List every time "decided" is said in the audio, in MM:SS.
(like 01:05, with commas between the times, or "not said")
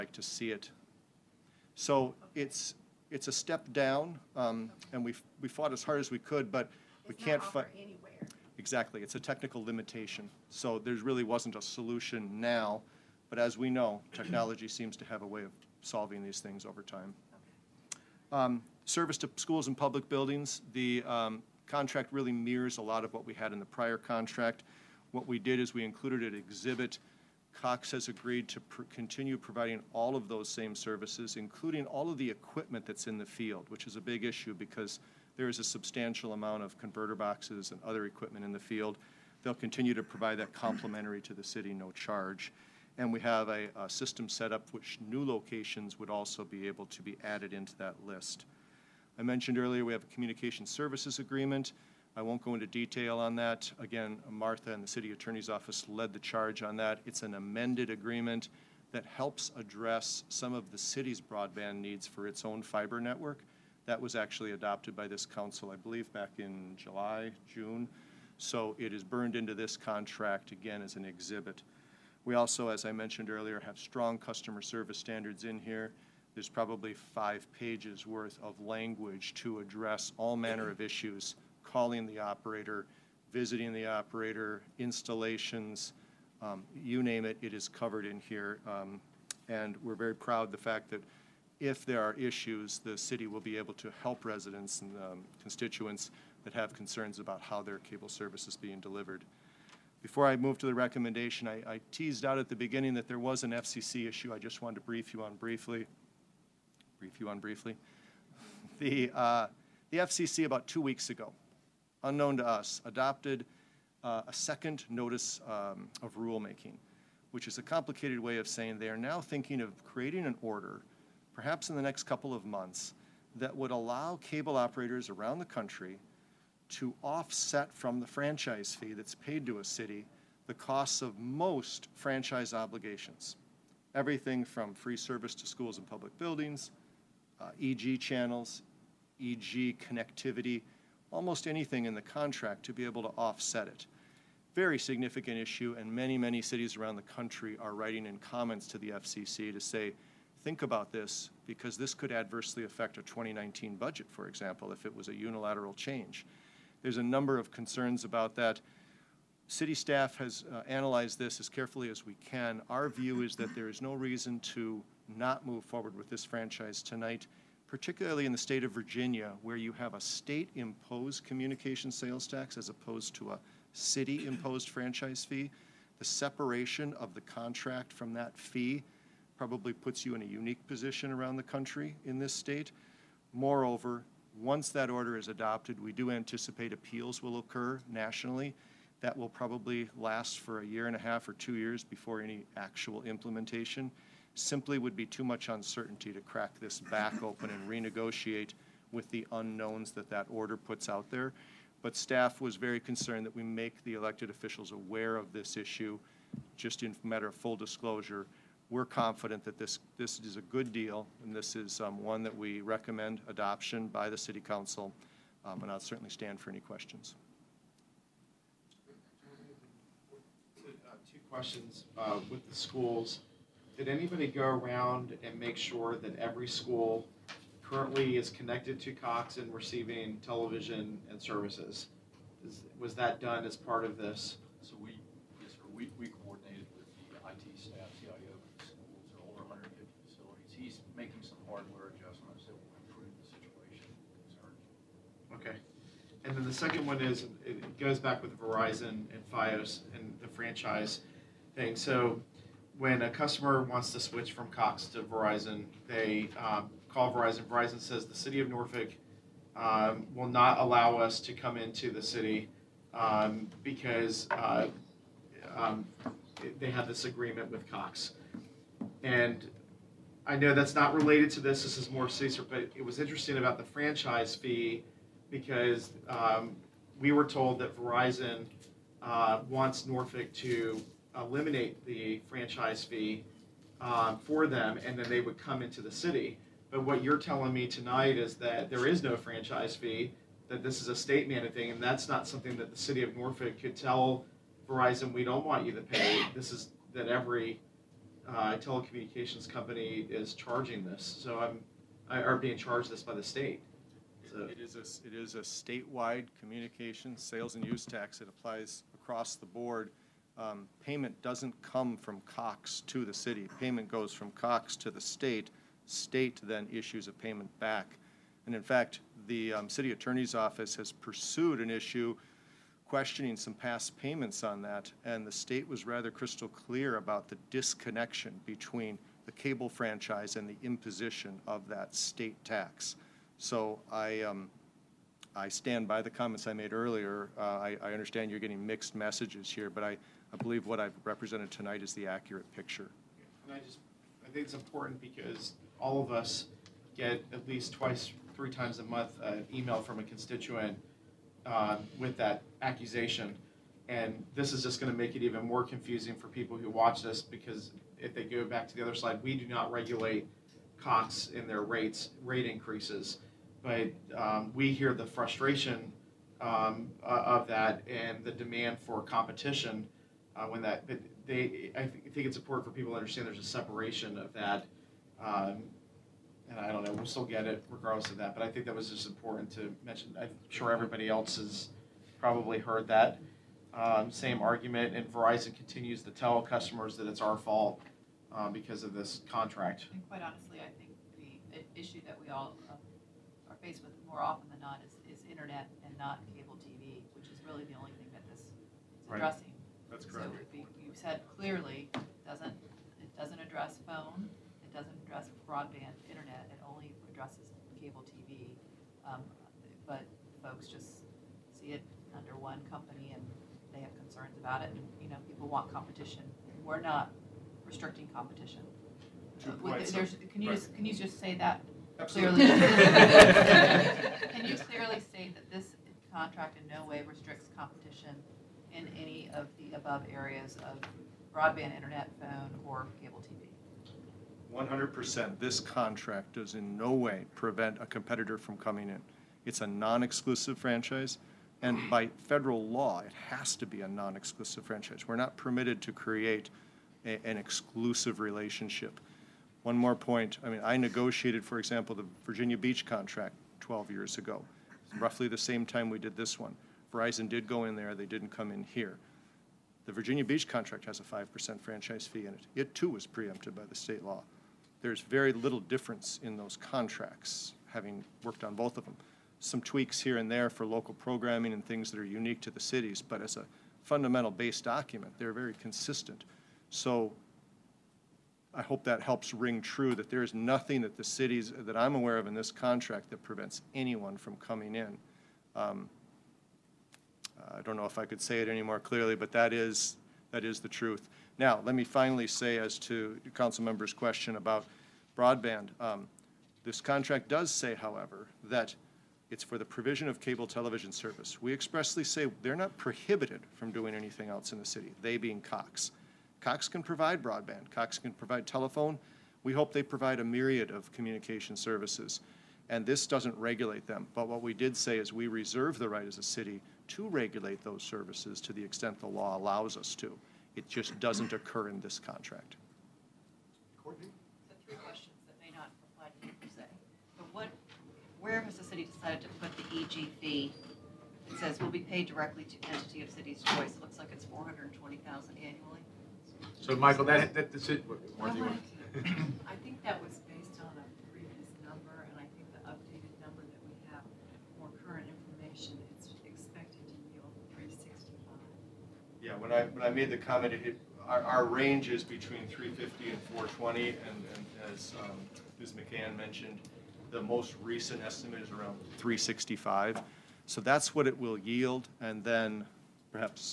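08:48.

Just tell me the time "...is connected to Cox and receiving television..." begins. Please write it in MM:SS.
03:48.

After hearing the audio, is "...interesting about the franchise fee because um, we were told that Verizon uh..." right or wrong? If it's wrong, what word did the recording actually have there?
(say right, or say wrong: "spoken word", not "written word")
right.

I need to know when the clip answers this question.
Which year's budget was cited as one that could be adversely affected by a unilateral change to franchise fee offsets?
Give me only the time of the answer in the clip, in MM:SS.
02:33.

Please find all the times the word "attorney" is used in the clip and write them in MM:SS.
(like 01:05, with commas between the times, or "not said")
00:55, 05:19.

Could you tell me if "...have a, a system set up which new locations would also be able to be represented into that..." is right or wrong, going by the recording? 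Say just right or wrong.
wrong.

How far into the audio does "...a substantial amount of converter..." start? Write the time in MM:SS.
00:35.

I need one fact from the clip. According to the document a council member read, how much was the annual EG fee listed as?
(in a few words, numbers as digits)
$420,000.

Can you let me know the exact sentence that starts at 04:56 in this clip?
This is that every uh, telecommunications company is charging this.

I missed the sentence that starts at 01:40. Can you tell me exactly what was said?
Before I move to the recommendation, I, I teased out at the beginning that there was an FCC issue.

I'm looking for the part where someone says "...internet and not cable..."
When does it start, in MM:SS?
06:35.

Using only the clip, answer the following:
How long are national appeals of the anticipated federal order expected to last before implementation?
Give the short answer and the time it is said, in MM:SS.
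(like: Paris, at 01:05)
a year and a half or two years, at 03:10.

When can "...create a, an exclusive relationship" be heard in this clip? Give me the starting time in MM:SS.
07:25.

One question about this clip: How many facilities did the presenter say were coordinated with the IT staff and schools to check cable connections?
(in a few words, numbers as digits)
150.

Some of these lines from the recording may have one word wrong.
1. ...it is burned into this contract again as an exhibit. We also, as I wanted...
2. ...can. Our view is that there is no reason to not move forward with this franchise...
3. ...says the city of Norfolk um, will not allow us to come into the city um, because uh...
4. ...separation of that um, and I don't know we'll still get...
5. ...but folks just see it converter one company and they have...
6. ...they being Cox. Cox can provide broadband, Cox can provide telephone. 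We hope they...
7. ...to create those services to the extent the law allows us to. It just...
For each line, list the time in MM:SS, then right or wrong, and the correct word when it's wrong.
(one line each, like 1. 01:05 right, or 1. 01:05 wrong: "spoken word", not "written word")
1. 01:08 wrong: "mentioned", not "wanted"
2. 02:42 right
3. 04:17 right
4. 06:13 right
5. 06:49 wrong: "under", not "converter"
6. 08:25 right
7. 08:36 wrong: "regulate", not "create".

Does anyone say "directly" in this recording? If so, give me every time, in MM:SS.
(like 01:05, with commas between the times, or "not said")
08:52.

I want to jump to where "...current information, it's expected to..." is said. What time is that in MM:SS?
09:04.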